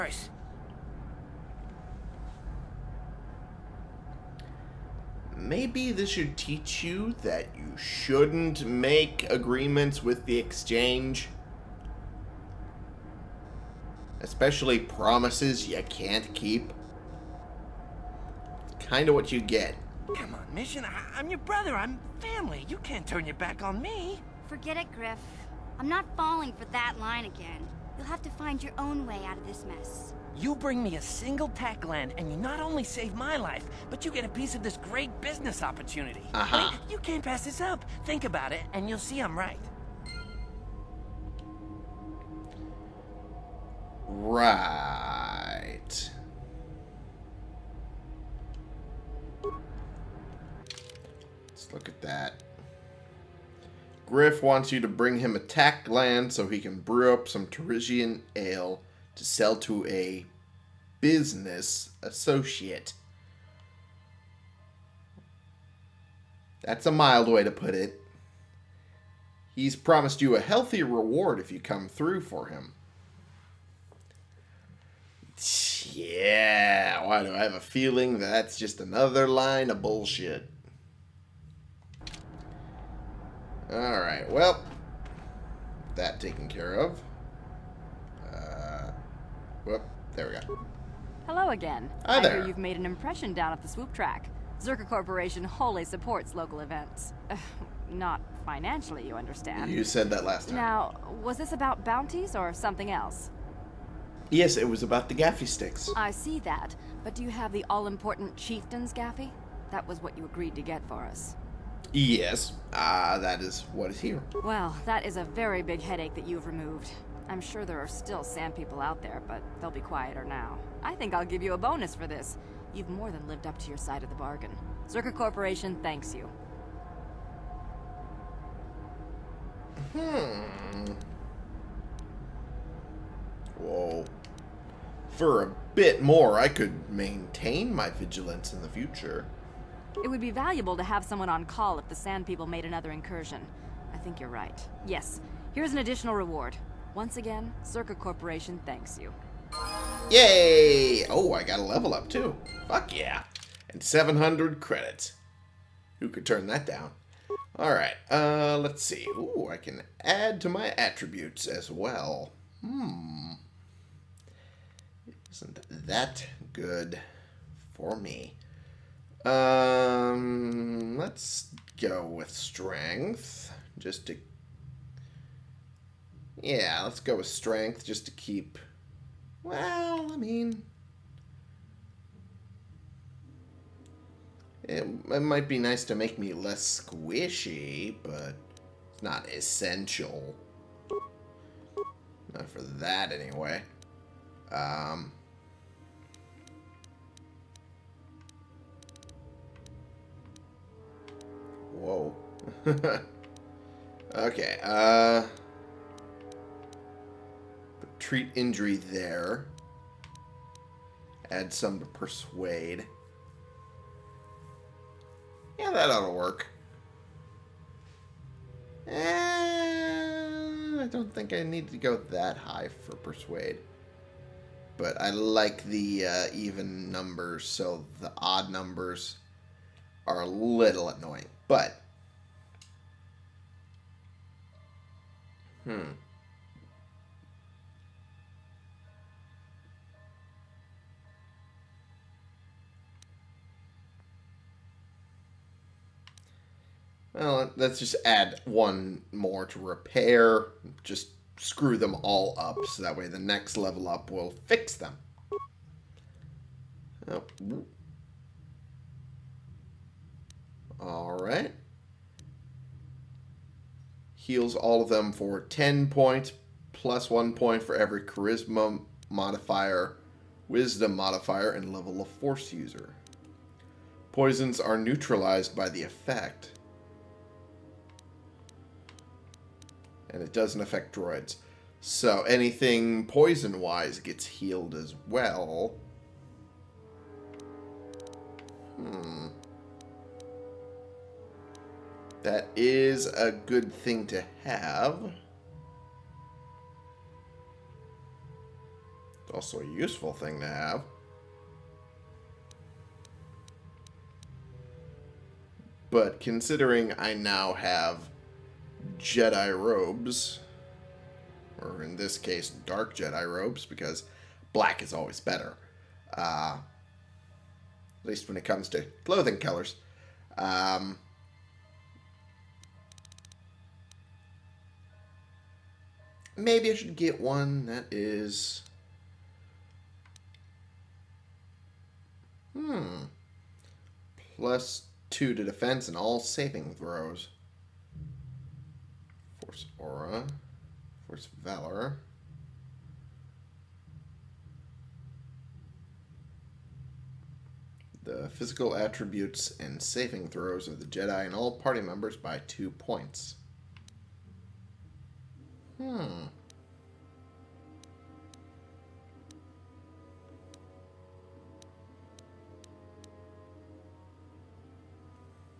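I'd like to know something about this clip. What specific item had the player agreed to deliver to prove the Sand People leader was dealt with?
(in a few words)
chieftain's gaffi.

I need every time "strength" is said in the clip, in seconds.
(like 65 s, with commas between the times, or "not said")
172 s, 177 s.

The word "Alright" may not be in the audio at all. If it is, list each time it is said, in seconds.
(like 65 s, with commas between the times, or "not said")
83 s, 157 s.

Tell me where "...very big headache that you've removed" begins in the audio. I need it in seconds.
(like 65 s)
115 s.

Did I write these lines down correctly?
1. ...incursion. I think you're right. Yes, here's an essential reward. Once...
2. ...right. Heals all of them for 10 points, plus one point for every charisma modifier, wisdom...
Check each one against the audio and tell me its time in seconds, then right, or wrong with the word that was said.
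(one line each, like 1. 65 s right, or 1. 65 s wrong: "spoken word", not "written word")
1. 142 s wrong: "additional", not "essential"
2. 261 s right.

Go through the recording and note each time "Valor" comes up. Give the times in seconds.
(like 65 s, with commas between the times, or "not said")
341 s.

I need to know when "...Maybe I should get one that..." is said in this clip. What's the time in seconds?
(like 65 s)
326 s.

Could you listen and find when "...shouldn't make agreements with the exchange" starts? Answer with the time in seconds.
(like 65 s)
7 s.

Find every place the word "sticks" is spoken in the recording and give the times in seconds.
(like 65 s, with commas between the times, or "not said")
105 s.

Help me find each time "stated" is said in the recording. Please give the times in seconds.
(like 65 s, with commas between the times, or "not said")
not said.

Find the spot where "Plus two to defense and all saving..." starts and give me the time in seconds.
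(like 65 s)
334 s.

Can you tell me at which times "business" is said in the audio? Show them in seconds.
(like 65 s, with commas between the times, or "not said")
35 s, 61 s.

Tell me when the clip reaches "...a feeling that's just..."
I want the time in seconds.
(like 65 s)
77 s.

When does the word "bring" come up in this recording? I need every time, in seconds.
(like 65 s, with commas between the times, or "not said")
30 s, 54 s.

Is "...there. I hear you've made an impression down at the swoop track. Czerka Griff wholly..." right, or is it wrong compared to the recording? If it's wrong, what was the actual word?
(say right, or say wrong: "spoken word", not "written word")
wrong: "Corporation", not "Griff".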